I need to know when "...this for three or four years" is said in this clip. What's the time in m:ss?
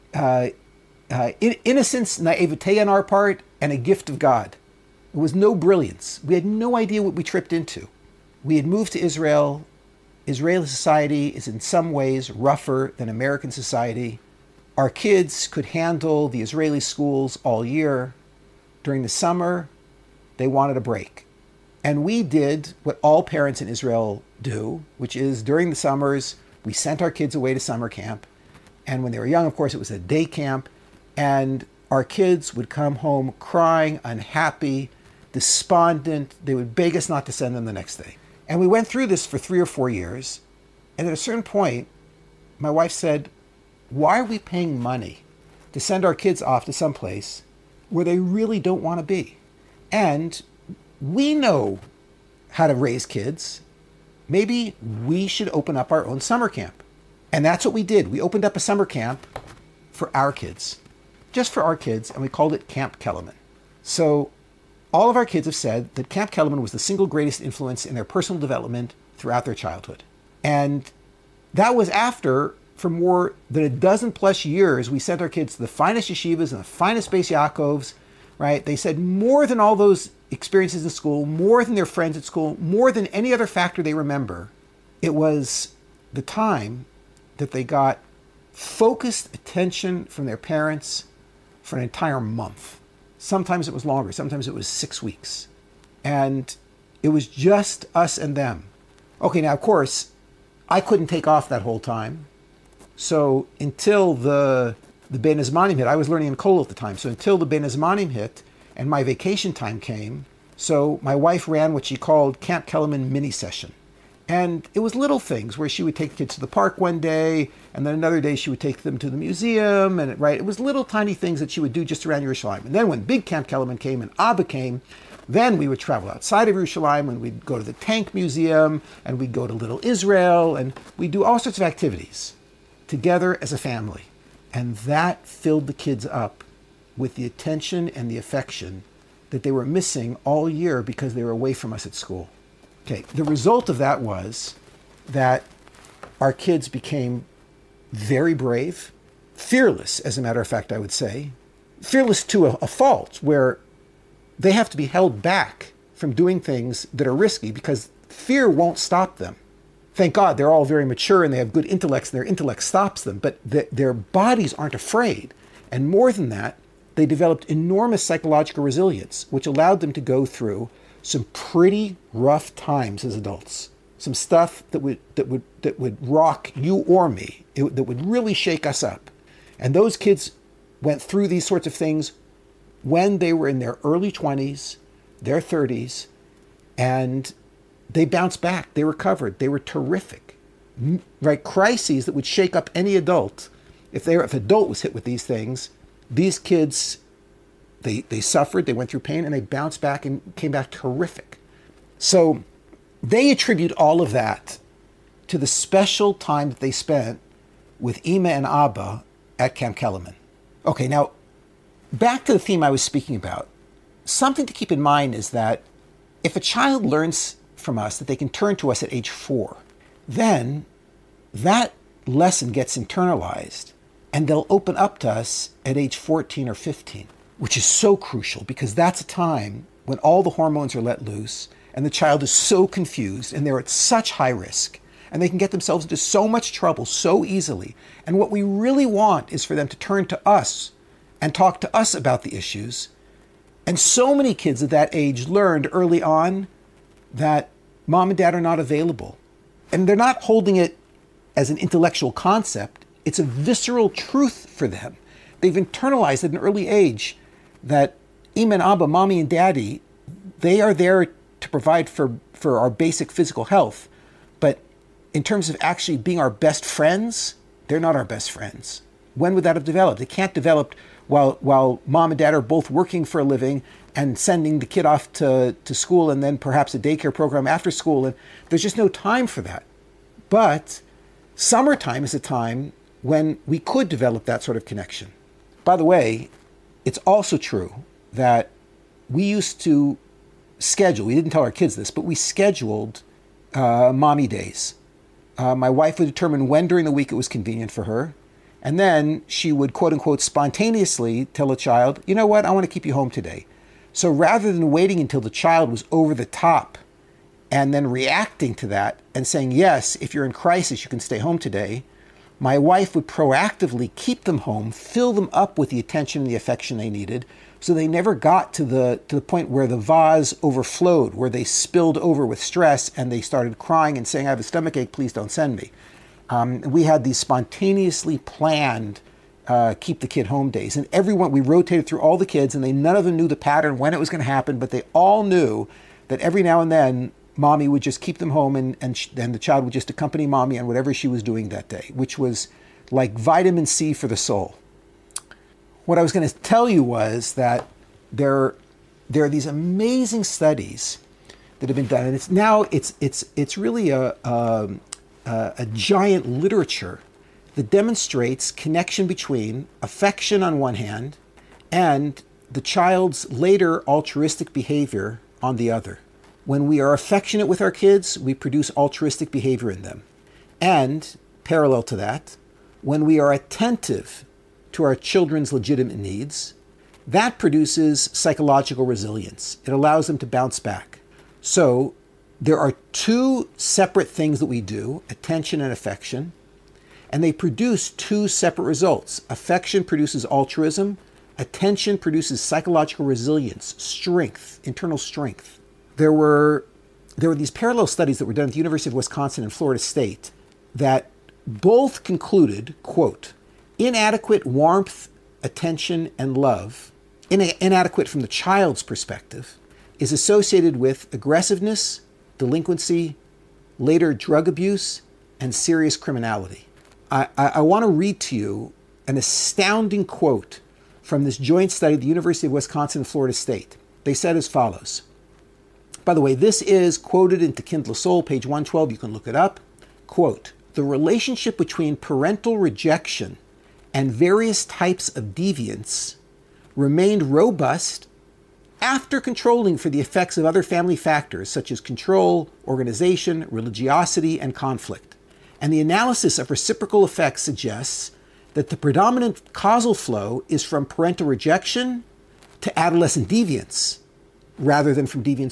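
0:39.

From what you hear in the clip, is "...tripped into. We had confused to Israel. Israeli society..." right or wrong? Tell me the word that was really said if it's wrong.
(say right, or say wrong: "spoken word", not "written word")
wrong: "moved", not "confused".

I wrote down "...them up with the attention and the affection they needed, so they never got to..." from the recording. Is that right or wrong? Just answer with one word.
right.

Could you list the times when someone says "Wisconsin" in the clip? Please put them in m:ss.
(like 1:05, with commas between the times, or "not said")
6:38, 7:02.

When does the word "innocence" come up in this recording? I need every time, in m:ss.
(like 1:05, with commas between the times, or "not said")
0:01.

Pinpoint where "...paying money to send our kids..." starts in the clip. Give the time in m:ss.
0:44.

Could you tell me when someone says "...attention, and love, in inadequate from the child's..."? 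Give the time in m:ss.
6:45.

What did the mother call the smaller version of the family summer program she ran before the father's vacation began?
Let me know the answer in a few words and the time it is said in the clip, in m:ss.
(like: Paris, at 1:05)
mini session, at 1:53.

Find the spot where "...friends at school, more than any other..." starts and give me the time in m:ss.
1:21.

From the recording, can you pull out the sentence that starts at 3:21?
So they attribute all of that to the special time that they spent with Ima and Abba at Camp Kelemen.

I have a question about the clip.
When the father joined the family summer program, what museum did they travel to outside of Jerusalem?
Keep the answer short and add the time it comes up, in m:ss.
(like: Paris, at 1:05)
Tank Museum, at 2:07.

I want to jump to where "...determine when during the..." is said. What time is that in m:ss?
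4:56.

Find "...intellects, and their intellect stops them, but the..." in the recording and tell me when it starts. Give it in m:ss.
2:41.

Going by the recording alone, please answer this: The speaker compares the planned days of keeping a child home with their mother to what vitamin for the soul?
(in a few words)
Vitamin C.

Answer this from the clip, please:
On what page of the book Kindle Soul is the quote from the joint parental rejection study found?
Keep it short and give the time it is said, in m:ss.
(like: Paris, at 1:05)
112, at 7:08.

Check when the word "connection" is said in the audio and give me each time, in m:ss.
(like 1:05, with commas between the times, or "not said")
4:44, 5:58.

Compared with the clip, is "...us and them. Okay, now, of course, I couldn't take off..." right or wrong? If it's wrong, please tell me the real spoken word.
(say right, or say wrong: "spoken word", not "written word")
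right.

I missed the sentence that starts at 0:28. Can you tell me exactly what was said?
And when they were young, of course, it was a day camp.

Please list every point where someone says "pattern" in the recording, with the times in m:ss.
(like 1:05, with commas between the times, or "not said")
5:33.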